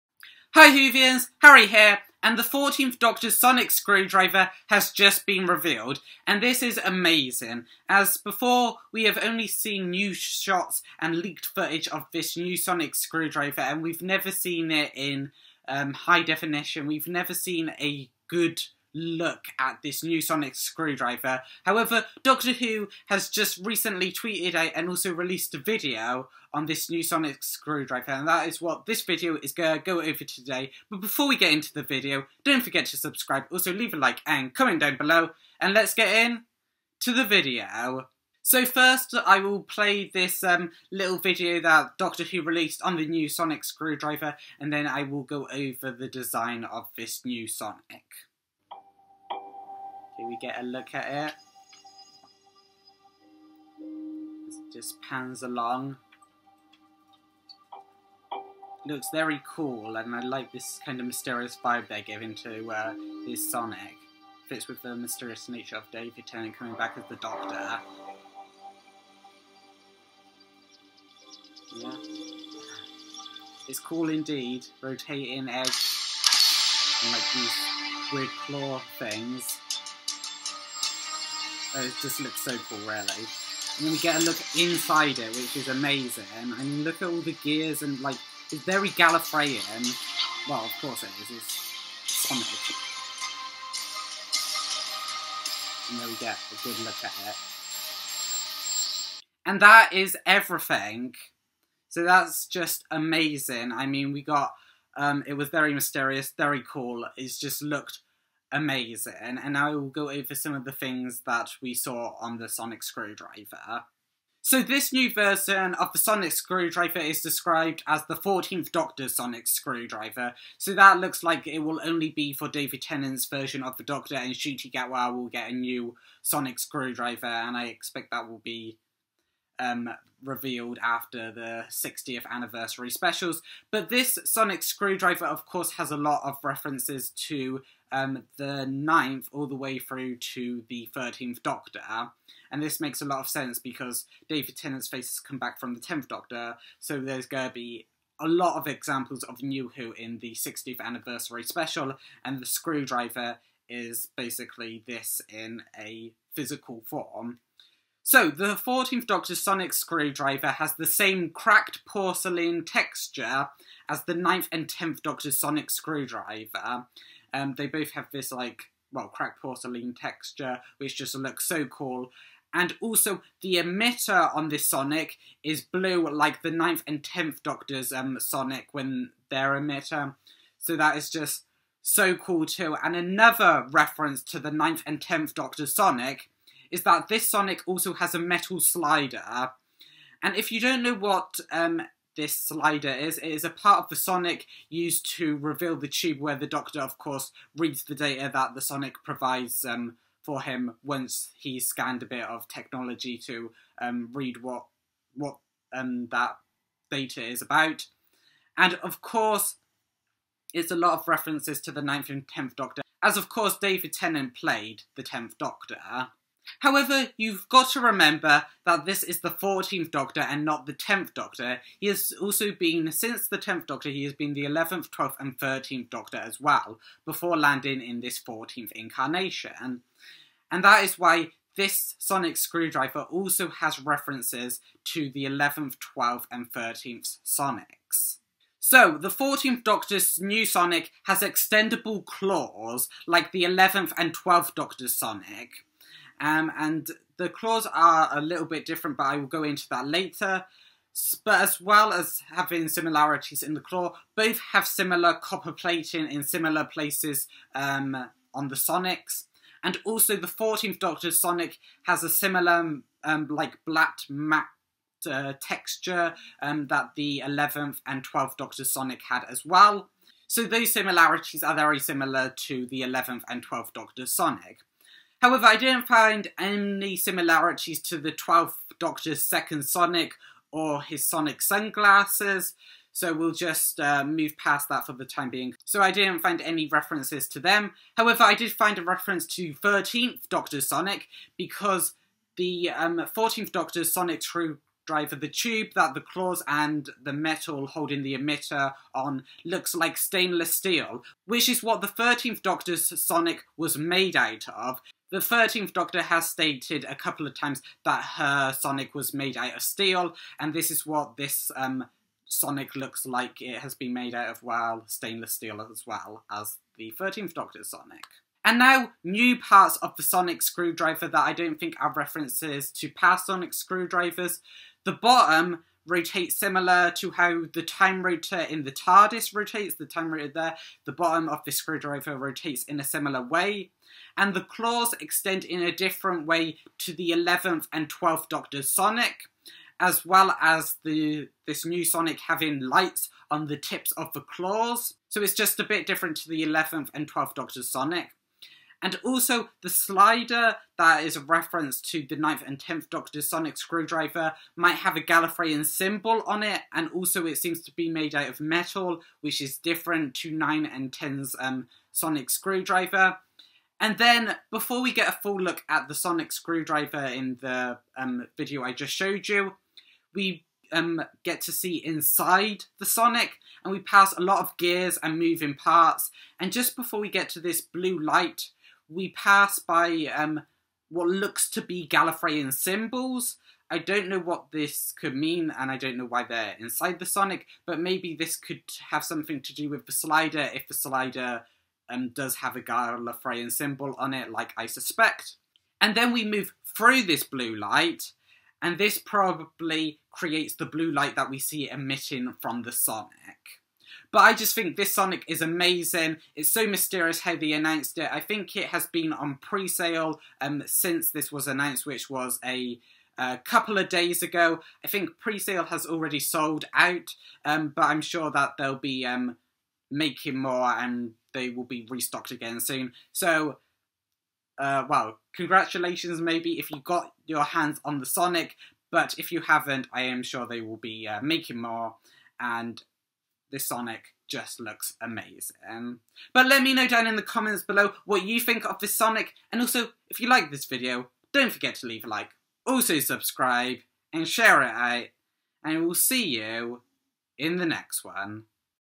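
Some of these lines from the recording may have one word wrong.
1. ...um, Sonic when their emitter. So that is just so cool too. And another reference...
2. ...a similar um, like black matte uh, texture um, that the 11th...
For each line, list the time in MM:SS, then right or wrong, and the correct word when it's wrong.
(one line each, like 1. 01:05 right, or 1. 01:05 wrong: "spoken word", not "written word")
1. 02:57 right
2. 04:22 right.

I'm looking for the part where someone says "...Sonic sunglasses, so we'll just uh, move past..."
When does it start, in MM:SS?
04:41.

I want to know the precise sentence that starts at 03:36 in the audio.
However, you've got to remember that this is the 14th Doctor and not the 10th Doctor.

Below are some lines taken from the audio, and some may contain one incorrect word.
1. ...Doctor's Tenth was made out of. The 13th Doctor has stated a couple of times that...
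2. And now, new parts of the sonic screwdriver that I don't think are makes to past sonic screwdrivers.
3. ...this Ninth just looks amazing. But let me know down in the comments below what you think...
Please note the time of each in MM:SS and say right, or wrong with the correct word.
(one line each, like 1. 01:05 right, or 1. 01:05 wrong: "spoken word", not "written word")
1. 05:02 wrong: "Sonic", not "Tenth"
2. 05:18 wrong: "references", not "makes"
3. 07:13 wrong: "Sonic", not "Ninth".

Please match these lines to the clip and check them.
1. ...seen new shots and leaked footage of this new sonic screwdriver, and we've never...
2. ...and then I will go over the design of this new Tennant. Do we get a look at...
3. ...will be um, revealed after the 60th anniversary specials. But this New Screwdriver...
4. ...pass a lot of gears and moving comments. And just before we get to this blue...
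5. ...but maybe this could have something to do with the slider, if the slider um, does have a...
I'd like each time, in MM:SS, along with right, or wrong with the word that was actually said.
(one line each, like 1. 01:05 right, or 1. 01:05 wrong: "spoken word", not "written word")
1. 00:09 right
2. 00:44 wrong: "Sonic", not "Tennant"
3. 02:08 wrong: "Sonic", not "New"
4. 06:13 wrong: "parts", not "comments"
5. 06:27 right.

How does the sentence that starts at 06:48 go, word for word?
I think it has been on pre-sale um, since this was announced, which was a a couple of days ago.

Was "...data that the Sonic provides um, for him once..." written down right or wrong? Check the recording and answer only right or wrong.
right.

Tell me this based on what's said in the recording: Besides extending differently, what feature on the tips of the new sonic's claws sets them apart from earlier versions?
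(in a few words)
lights.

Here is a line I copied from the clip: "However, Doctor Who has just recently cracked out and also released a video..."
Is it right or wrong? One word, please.
wrong.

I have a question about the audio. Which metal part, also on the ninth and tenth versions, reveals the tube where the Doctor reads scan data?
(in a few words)
metal slider.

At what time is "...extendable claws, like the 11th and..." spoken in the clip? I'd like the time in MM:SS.
04:01.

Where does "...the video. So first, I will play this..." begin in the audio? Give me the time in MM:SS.
00:37.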